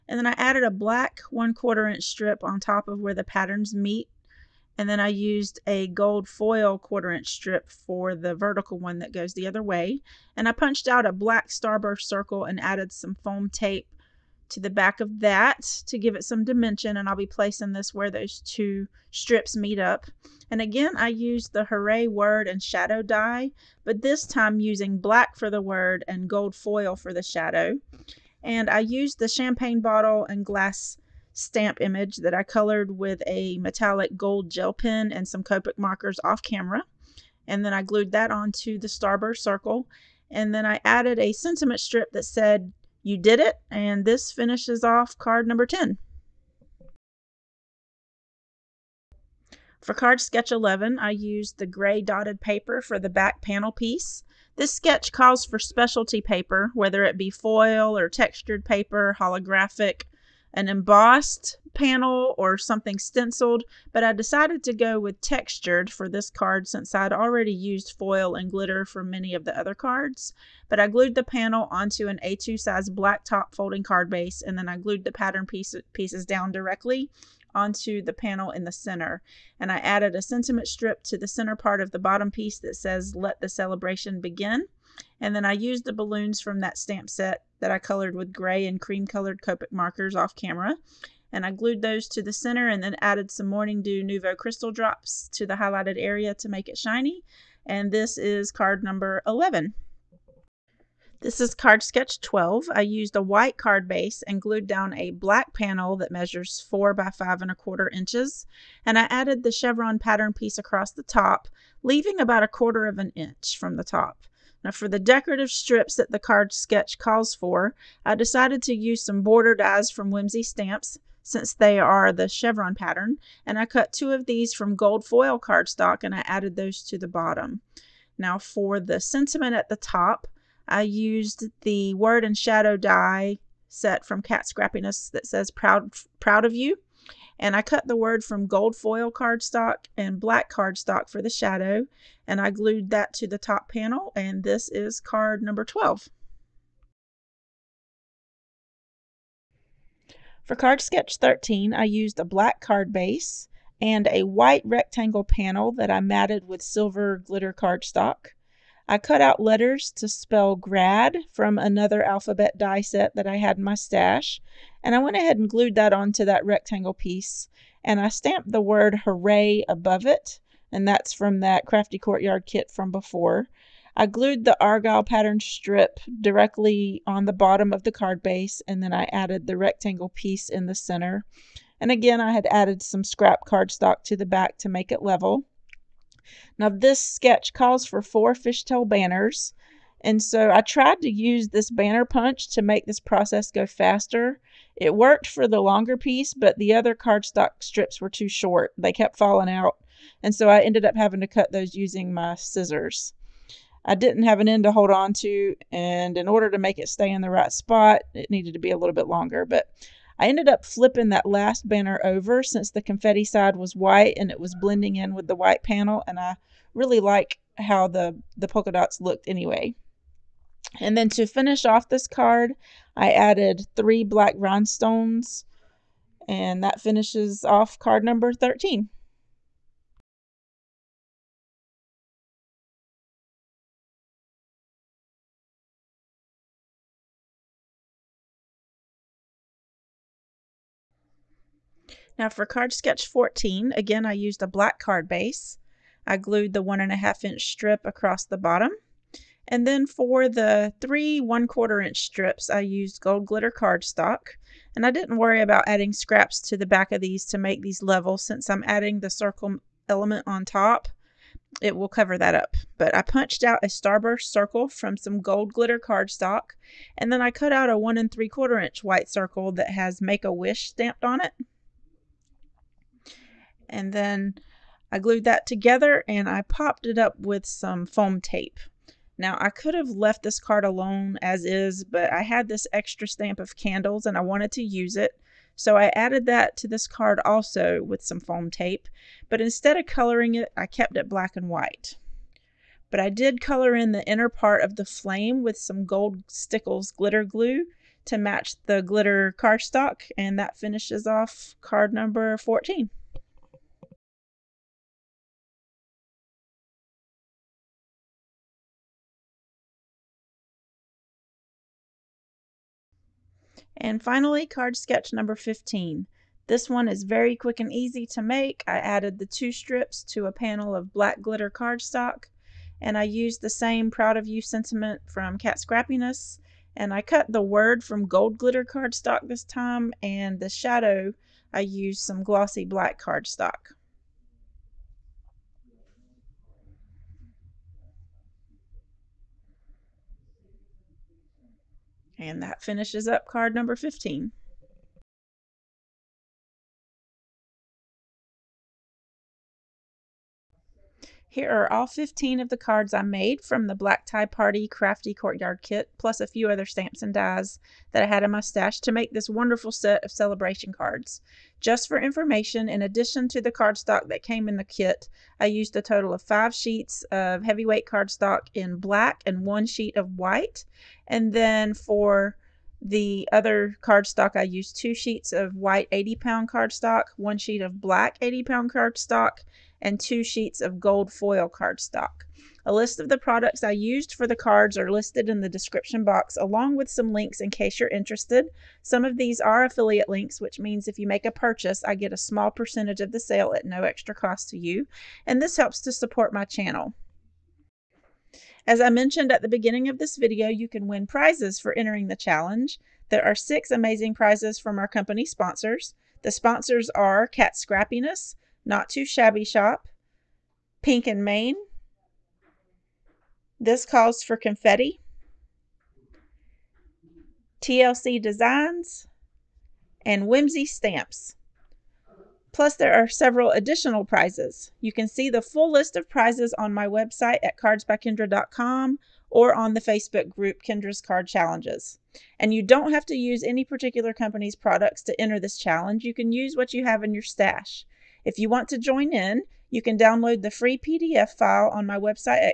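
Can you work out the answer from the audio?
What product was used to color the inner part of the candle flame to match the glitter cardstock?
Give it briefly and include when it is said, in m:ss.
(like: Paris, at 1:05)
gold stickles glitter glue, at 4:55.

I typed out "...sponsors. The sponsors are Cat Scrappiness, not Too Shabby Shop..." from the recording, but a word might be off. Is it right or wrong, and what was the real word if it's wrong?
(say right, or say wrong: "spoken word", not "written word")
right.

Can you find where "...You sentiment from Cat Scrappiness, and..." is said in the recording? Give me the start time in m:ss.
5:24.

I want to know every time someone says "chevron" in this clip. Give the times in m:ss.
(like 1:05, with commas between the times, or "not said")
1:49, 2:02.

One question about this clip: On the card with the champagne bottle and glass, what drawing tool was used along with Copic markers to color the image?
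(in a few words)
metallic gold gel pen.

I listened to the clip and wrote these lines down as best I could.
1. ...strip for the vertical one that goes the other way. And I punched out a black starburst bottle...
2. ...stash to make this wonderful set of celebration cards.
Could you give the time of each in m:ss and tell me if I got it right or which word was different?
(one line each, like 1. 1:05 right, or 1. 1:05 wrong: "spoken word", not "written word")
1. 0:07 wrong: "circle", not "bottle"
2. 5:58 right.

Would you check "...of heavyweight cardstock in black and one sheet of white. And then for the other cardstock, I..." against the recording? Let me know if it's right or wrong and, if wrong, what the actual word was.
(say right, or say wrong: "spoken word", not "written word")
right.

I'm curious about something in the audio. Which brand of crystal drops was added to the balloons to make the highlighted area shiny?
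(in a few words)
Morning Dew Nuvo.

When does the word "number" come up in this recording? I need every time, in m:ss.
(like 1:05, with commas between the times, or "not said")
0:45, 1:38, 2:25, 3:48, 5:01, 5:15, 5:43.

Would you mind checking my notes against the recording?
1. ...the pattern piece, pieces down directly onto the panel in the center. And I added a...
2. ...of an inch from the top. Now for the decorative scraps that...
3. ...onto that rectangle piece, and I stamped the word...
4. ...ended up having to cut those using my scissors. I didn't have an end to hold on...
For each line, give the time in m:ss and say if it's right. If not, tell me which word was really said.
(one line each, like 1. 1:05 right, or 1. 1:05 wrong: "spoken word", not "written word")
1. 1:15 right
2. 1:52 wrong: "strips", not "scraps"
3. 2:45 right
4. 3:20 right.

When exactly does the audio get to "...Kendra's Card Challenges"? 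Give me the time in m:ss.
7:10.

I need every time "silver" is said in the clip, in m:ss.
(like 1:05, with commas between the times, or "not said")
2:36.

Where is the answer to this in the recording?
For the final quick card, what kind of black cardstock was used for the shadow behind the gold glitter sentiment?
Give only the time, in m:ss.
5:32.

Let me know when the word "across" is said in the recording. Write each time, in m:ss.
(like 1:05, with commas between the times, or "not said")
1:50, 4:07.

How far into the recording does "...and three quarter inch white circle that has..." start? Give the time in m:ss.
4:27.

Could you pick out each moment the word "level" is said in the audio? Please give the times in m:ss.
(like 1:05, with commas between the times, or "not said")
3:05, 4:17.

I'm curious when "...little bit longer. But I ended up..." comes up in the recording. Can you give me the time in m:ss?
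3:28.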